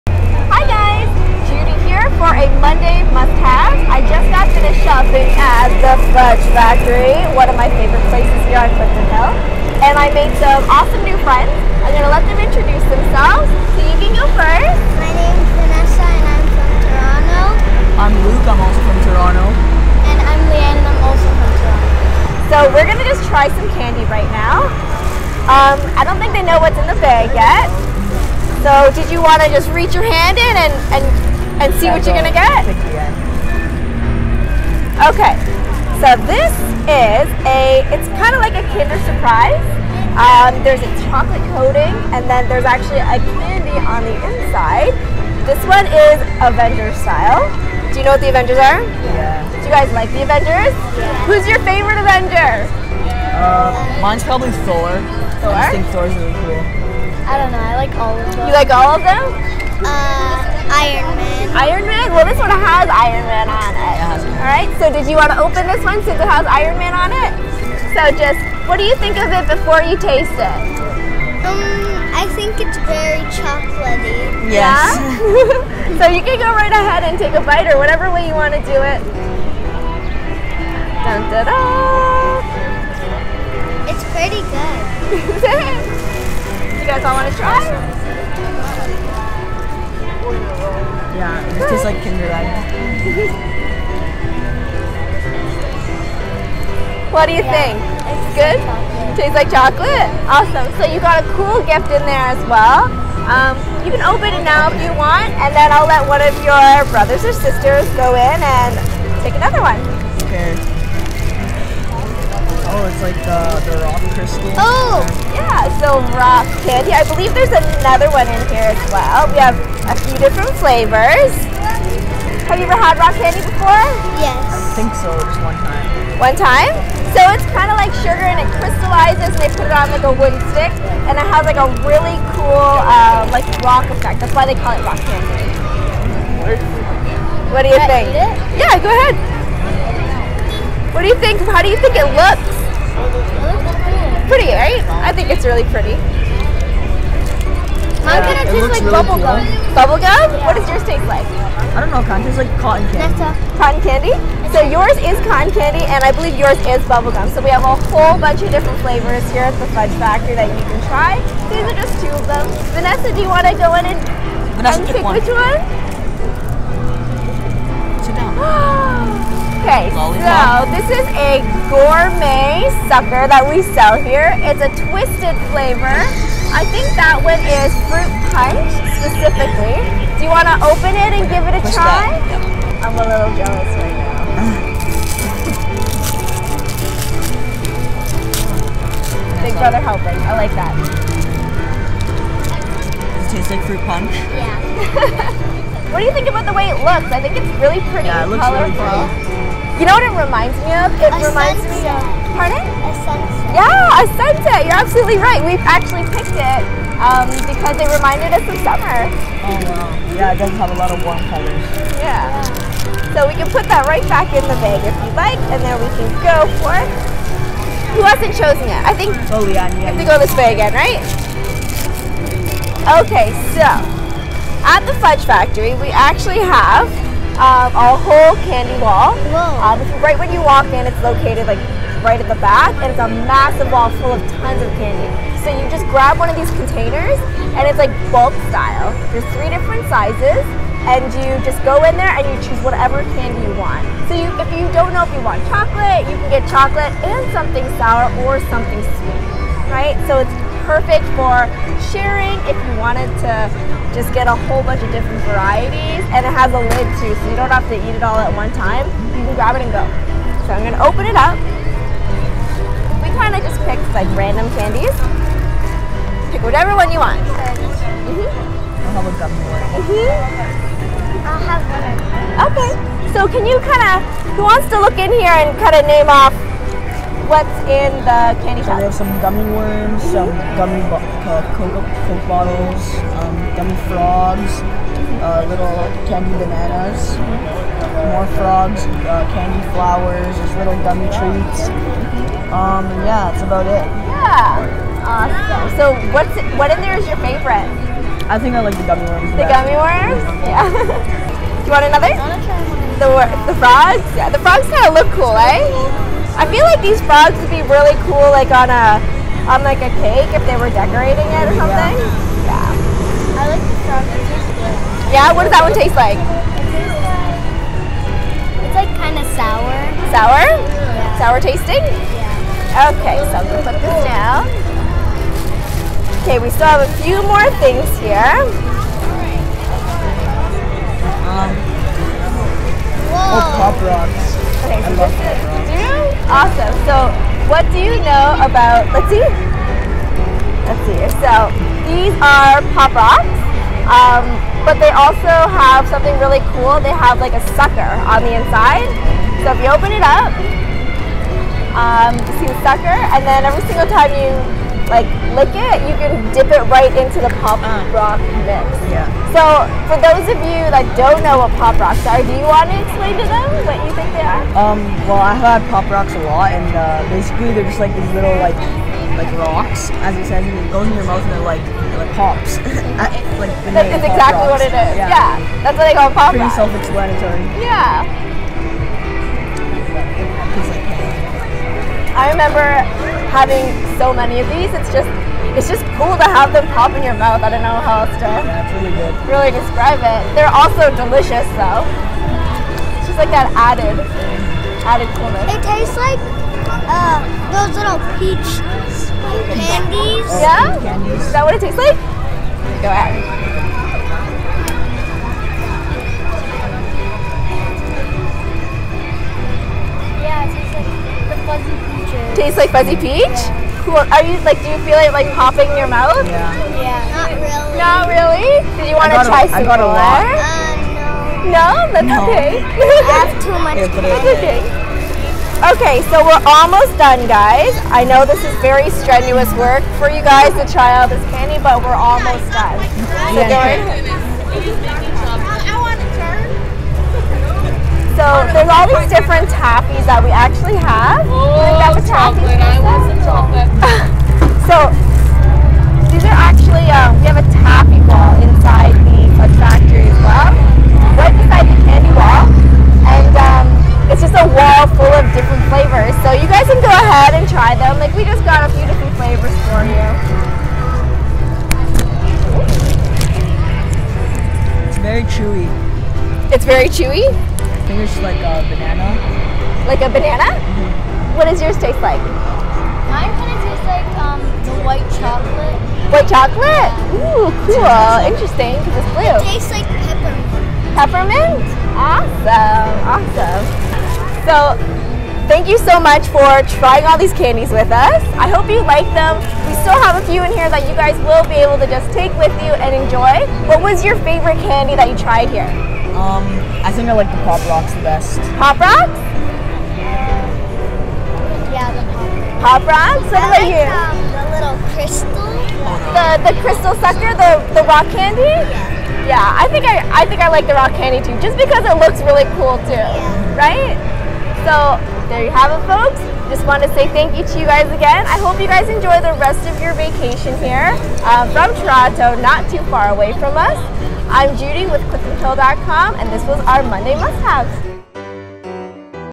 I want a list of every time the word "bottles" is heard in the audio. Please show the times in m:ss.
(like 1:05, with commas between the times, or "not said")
4:42.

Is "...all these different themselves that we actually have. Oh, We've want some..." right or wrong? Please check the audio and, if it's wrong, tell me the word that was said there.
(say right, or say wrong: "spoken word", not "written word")
wrong: "taffies", not "themselves".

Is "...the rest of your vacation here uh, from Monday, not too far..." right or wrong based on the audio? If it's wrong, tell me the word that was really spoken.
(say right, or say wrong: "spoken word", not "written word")
wrong: "Toronto", not "Monday".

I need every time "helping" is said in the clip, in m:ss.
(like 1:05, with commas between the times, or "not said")
3:09.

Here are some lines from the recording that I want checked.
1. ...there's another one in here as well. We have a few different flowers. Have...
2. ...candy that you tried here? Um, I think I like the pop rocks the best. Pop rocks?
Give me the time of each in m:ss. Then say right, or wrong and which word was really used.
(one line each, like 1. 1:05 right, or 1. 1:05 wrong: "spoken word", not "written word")
1. 1:57 wrong: "flavors", not "flowers"
2. 8:14 right.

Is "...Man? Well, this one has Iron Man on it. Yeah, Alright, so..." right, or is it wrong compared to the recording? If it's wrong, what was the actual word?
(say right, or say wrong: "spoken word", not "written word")
right.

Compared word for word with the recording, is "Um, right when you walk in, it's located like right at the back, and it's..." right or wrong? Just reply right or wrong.
right.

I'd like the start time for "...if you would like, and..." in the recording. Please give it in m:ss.
3:34.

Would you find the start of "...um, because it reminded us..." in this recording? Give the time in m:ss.
3:26.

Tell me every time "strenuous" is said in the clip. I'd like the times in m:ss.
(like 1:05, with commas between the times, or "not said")
7:08.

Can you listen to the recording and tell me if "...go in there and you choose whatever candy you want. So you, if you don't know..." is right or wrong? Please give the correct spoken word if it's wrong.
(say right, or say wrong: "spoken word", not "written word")
right.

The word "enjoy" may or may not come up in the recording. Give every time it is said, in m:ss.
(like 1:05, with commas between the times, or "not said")
8:13, 8:38.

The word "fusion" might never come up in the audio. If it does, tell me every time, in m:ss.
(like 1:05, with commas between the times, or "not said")
not said.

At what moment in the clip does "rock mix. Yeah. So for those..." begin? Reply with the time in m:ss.
5:57.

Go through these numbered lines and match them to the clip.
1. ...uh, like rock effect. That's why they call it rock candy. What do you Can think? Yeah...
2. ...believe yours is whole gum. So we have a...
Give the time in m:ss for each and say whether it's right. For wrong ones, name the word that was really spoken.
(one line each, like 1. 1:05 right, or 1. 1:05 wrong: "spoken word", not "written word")
1. 2:12 right
2. 2:36 wrong: "bubble", not "whole".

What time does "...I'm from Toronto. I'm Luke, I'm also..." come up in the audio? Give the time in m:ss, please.
0:16.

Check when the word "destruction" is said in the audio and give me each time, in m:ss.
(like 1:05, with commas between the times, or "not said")
not said.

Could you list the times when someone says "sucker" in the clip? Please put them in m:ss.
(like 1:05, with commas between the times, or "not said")
2:52, 5:47, 5:52, 8:27.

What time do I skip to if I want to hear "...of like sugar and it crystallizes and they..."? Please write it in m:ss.
2:07.